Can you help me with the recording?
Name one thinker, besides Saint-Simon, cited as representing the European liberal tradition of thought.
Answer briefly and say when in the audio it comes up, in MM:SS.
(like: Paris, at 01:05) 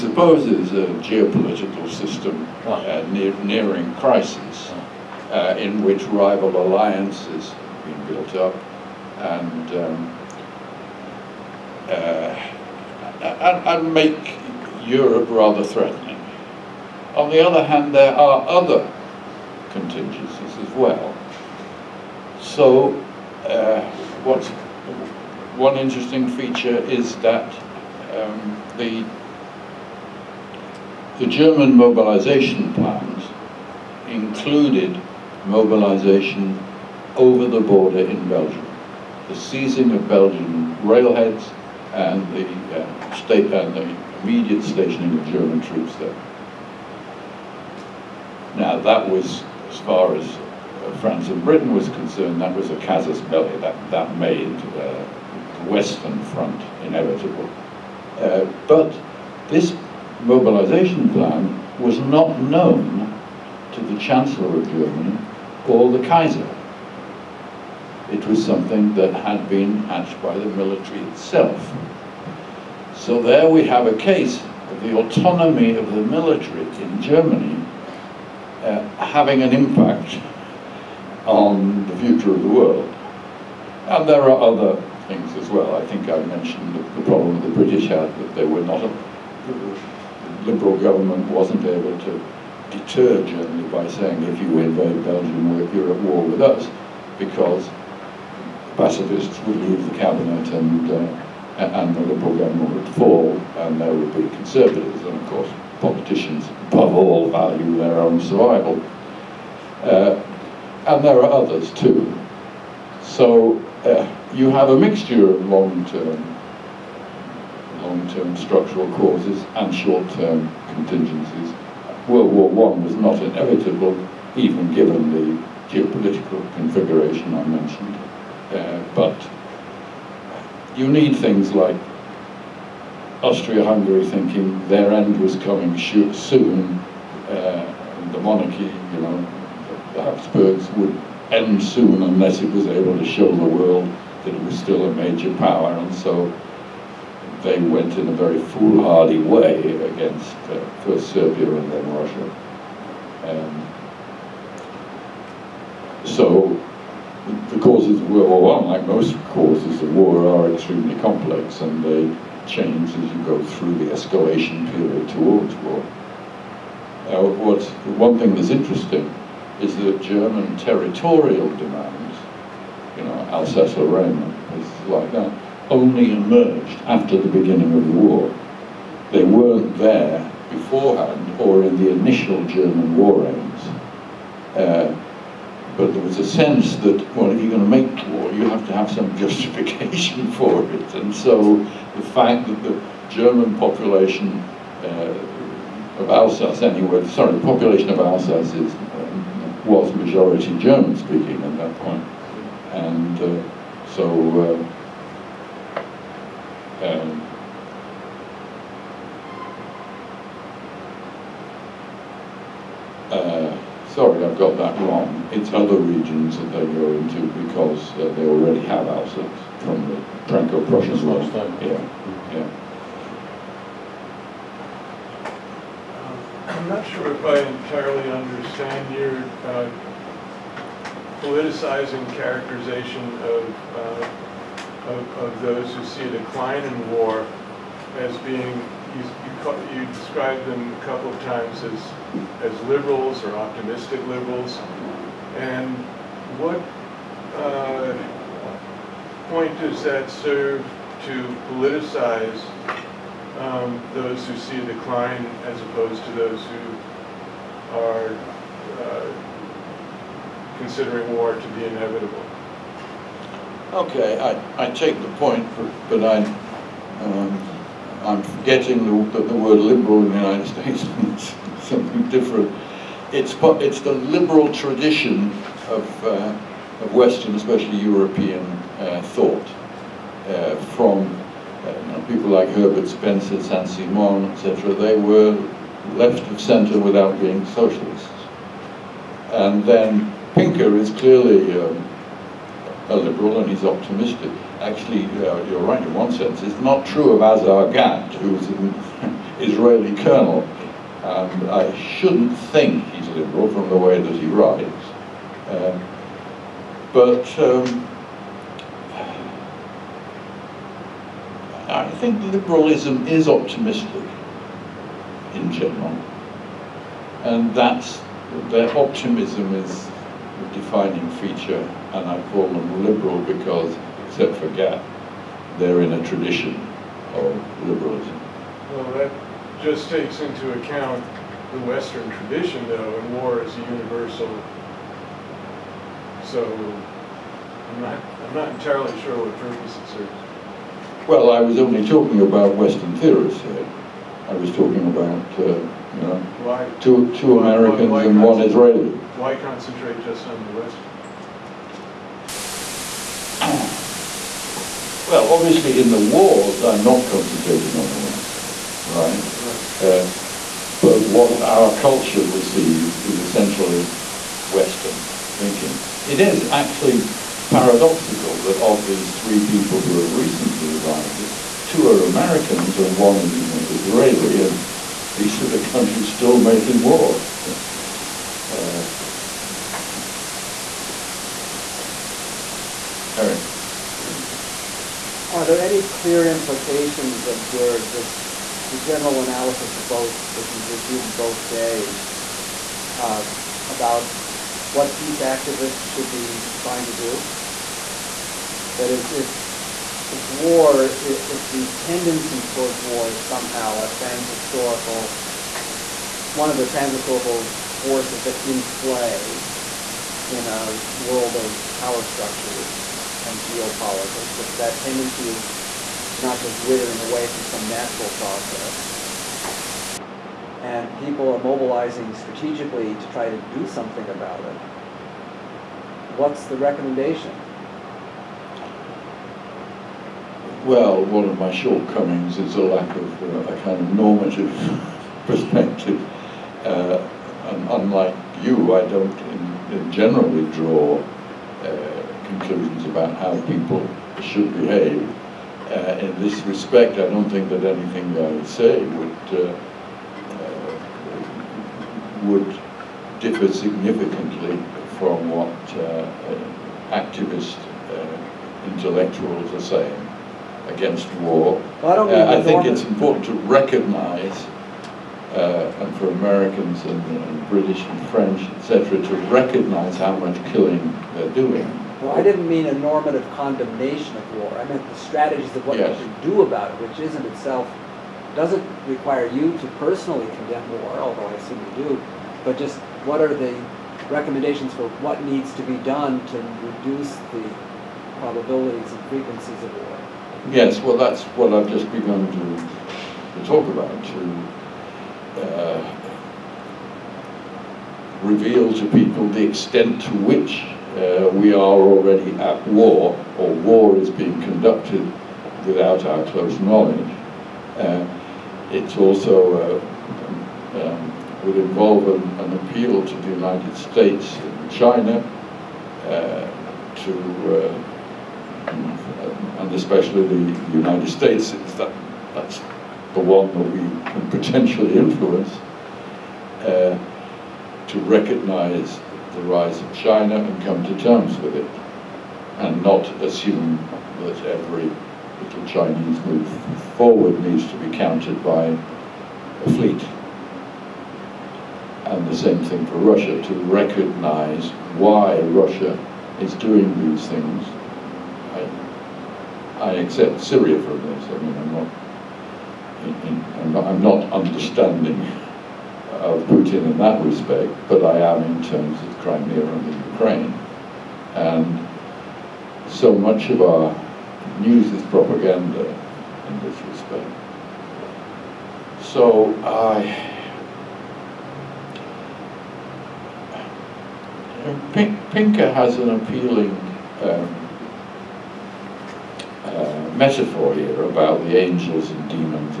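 Herbert Spencer, at 04:42.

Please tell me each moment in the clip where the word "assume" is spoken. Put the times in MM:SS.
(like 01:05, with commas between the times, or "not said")
08:01, 08:53.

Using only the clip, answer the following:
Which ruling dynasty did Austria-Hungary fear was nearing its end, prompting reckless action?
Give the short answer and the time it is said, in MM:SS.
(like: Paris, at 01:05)
The Habsburgs, at 02:19.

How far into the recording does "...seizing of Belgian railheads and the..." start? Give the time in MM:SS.
00:39.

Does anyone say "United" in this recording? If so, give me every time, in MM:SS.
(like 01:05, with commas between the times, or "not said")
04:30, 08:33, 08:40.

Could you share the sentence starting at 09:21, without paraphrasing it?
And so much of our news is propaganda in this respect.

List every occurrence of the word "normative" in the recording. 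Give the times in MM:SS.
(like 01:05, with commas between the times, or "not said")
07:13, 07:52.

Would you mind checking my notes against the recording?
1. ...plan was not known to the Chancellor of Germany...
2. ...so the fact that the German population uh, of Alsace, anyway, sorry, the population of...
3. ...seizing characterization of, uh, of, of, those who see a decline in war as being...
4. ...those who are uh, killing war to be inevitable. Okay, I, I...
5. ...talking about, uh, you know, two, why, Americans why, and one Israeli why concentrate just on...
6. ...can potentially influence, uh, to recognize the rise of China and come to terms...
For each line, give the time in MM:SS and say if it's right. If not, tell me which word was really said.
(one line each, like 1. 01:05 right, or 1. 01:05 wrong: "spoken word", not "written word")
1. 01:01 right
2. 03:11 right
3. 03:51 wrong: "politicizing", not "seizing"
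4. 04:16 wrong: "considering", not "killing"
5. 05:44 right
6. 08:44 right.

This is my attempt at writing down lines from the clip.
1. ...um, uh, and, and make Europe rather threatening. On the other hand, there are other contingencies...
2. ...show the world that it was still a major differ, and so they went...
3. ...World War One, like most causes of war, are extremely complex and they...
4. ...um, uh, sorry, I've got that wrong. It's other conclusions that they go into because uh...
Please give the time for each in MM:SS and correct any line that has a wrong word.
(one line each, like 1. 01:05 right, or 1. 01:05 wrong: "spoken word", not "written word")
1. 00:09 right
2. 02:23 wrong: "power", not "differ"
3. 02:38 right
4. 03:26 wrong: "regions", not "conclusions".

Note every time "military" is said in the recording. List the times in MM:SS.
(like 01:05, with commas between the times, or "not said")
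01:10, 01:16.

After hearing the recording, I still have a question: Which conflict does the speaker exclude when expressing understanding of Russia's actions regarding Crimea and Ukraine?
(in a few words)
Syria.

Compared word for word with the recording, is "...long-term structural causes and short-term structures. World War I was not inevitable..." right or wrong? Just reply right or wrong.
wrong.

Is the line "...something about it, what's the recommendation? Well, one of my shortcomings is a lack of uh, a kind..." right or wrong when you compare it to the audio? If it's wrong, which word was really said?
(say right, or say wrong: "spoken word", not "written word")
right.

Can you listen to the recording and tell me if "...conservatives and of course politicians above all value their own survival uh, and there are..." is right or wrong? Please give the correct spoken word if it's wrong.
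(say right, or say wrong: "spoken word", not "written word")
right.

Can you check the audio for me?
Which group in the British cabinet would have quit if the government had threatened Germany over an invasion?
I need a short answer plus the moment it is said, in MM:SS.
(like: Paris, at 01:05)
Pacifists, at 01:38.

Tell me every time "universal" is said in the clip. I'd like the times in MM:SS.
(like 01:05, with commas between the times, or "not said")
05:33.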